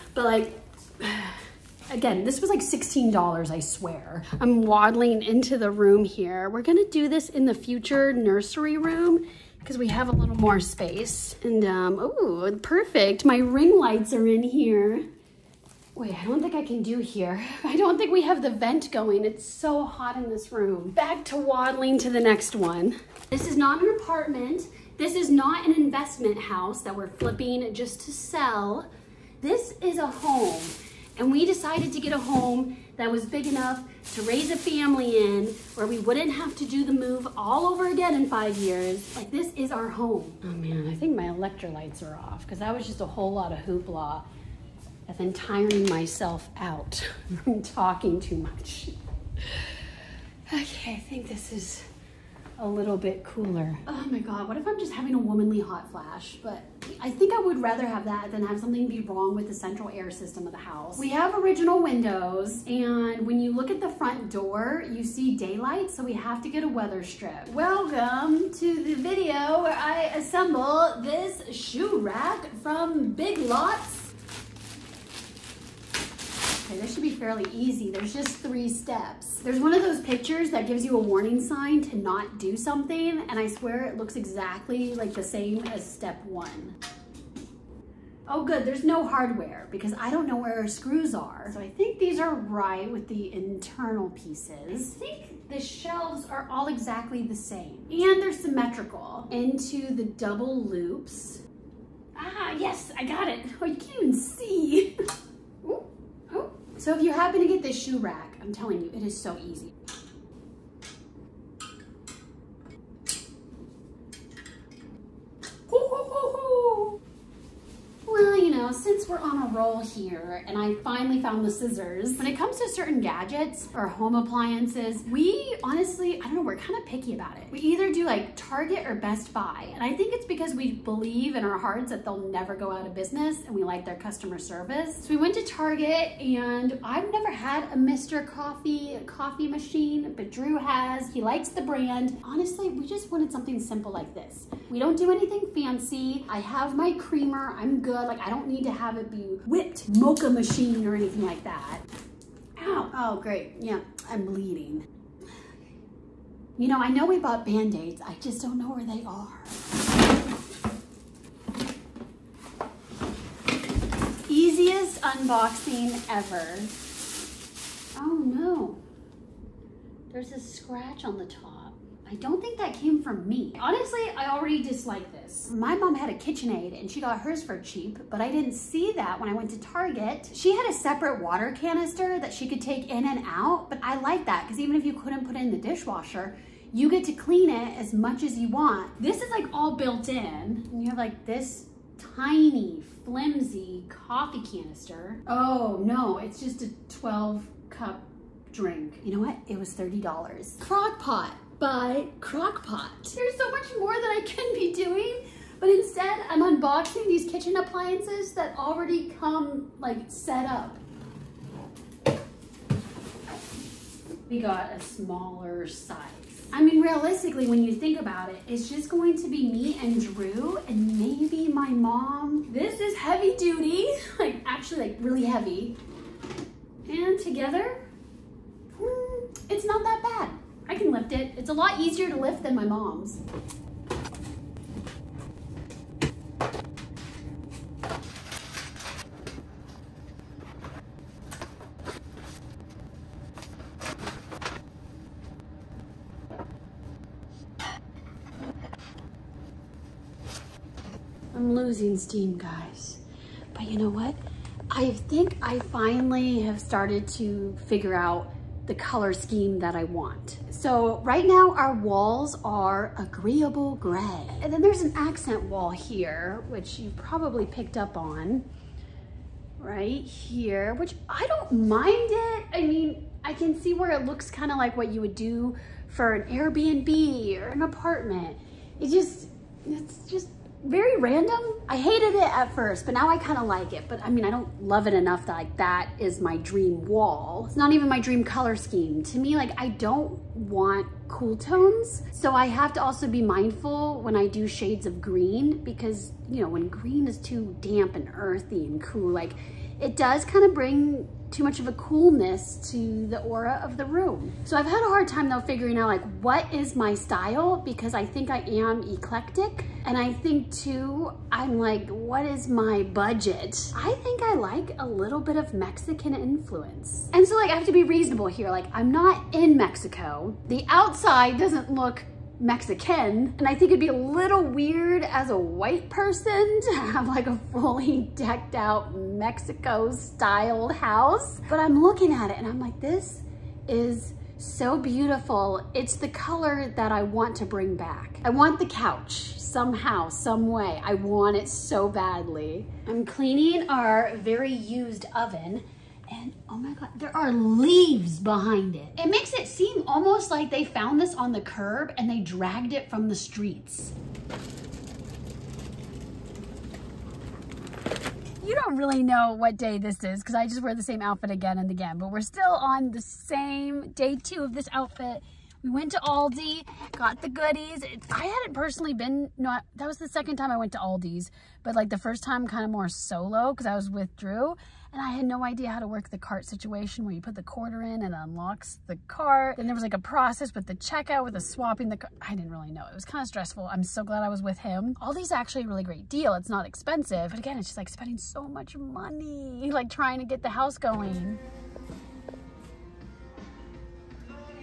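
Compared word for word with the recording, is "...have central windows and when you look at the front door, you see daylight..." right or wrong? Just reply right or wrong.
wrong.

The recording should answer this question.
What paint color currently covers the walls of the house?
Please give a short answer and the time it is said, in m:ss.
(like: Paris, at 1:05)
Agreeable Gray, at 4:22.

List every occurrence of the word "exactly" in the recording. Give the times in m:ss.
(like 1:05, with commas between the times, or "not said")
1:24, 1:36.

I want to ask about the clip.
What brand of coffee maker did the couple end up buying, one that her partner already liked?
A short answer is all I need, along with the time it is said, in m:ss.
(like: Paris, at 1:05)
Mr. Coffee, at 2:17.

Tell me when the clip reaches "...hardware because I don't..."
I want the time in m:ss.
1:29.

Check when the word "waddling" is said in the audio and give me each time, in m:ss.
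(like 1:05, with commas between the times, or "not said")
0:04, 0:21.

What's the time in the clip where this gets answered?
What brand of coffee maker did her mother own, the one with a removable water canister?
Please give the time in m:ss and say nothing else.
2:56.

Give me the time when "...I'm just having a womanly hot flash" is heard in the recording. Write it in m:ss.
0:54.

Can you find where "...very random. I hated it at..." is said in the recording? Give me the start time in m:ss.
4:40.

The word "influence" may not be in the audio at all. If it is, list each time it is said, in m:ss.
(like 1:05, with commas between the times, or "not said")
5:16.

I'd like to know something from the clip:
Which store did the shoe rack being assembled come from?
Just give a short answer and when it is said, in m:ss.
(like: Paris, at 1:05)
Big Lots, at 1:13.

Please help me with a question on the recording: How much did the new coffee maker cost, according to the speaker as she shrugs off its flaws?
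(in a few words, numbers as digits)
$30.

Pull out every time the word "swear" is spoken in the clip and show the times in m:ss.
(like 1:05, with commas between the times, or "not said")
0:03, 1:23.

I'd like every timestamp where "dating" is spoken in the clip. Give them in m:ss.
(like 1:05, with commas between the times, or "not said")
not said.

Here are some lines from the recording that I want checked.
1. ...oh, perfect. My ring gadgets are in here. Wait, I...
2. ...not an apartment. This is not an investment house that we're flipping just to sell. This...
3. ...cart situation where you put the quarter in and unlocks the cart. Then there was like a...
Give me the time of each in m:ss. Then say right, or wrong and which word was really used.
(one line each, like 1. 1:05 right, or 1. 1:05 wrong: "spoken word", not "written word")
1. 0:11 wrong: "lights", not "gadgets"
2. 0:23 right
3. 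6:16 right.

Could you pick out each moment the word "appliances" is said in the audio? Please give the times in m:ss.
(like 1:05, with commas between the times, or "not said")
2:04, 3:27.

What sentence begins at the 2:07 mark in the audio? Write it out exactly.
We either do like Target or Best Buy.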